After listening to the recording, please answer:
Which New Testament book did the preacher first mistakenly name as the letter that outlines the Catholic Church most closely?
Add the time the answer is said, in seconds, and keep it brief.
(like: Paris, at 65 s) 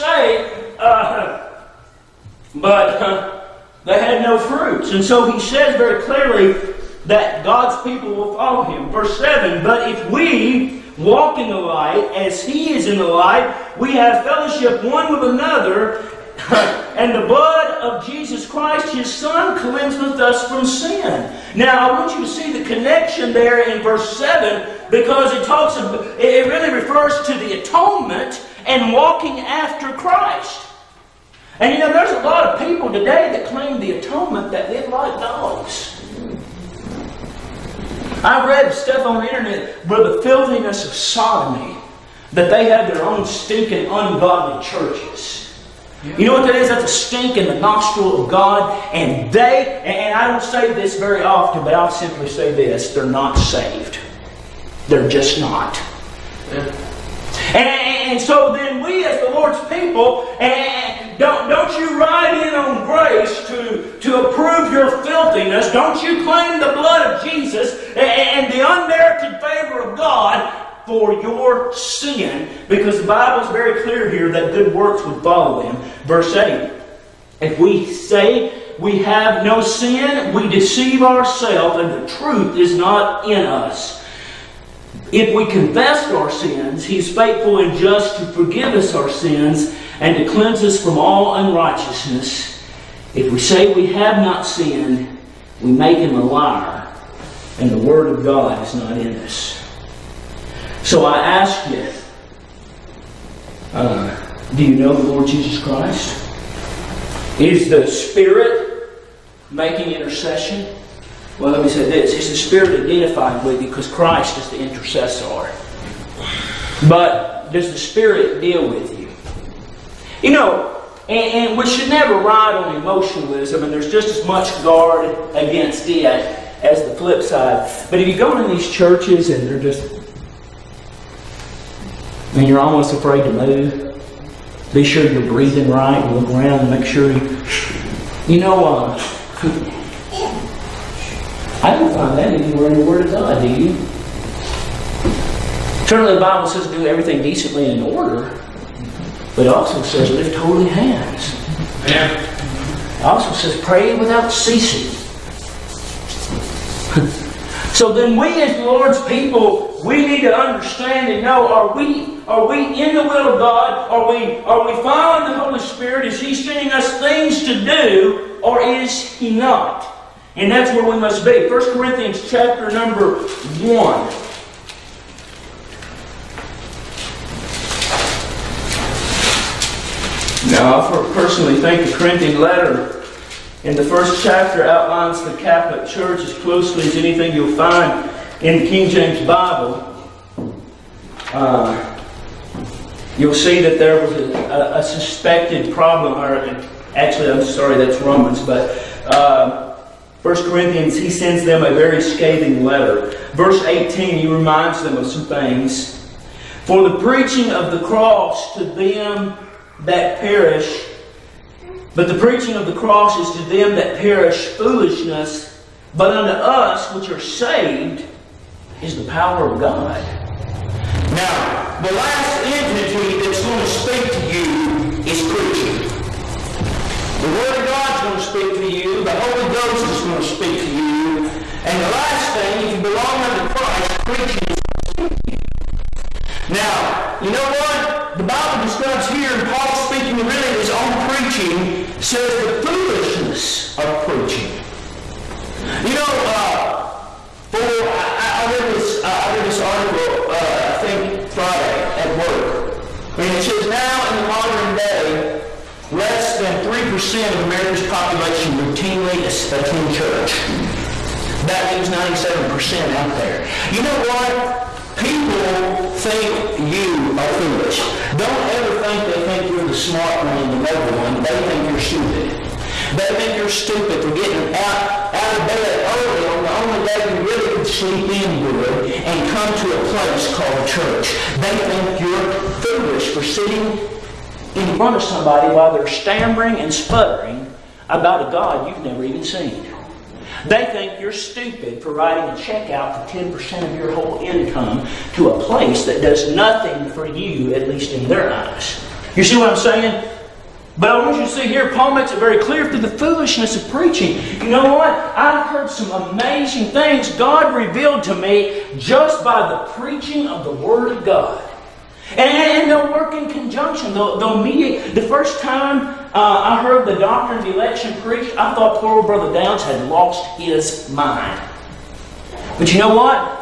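Romans, at 198 s.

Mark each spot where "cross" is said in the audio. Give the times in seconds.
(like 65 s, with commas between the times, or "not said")
207 s, 212 s.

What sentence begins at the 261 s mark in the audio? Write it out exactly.
That leaves ninety seven percent out there.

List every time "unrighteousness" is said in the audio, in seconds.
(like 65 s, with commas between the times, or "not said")
91 s.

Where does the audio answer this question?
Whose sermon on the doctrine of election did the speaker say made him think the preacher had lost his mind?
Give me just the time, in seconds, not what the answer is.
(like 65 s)
319 s.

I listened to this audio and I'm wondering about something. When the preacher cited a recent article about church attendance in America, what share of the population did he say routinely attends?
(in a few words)
less than 3%.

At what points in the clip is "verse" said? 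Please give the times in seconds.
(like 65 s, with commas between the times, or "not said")
8 s, 23 s, 76 s, 203 s.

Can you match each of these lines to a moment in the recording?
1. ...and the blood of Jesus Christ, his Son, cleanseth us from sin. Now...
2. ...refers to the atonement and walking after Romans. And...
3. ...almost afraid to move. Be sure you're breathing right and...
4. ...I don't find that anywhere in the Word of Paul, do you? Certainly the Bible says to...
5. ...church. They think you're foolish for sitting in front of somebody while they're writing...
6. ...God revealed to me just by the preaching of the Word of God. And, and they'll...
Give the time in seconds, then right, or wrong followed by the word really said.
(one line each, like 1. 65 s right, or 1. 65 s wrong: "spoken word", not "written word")
1. 16 s right
2. 26 s wrong: "Christ", not "Romans"
3. 132 s right
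4. 141 s wrong: "God", not "Paul"
5. 280 s wrong: "stammering", not "writing"
6. 307 s right.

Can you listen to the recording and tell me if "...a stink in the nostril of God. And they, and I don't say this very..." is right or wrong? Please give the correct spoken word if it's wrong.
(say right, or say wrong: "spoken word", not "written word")
right.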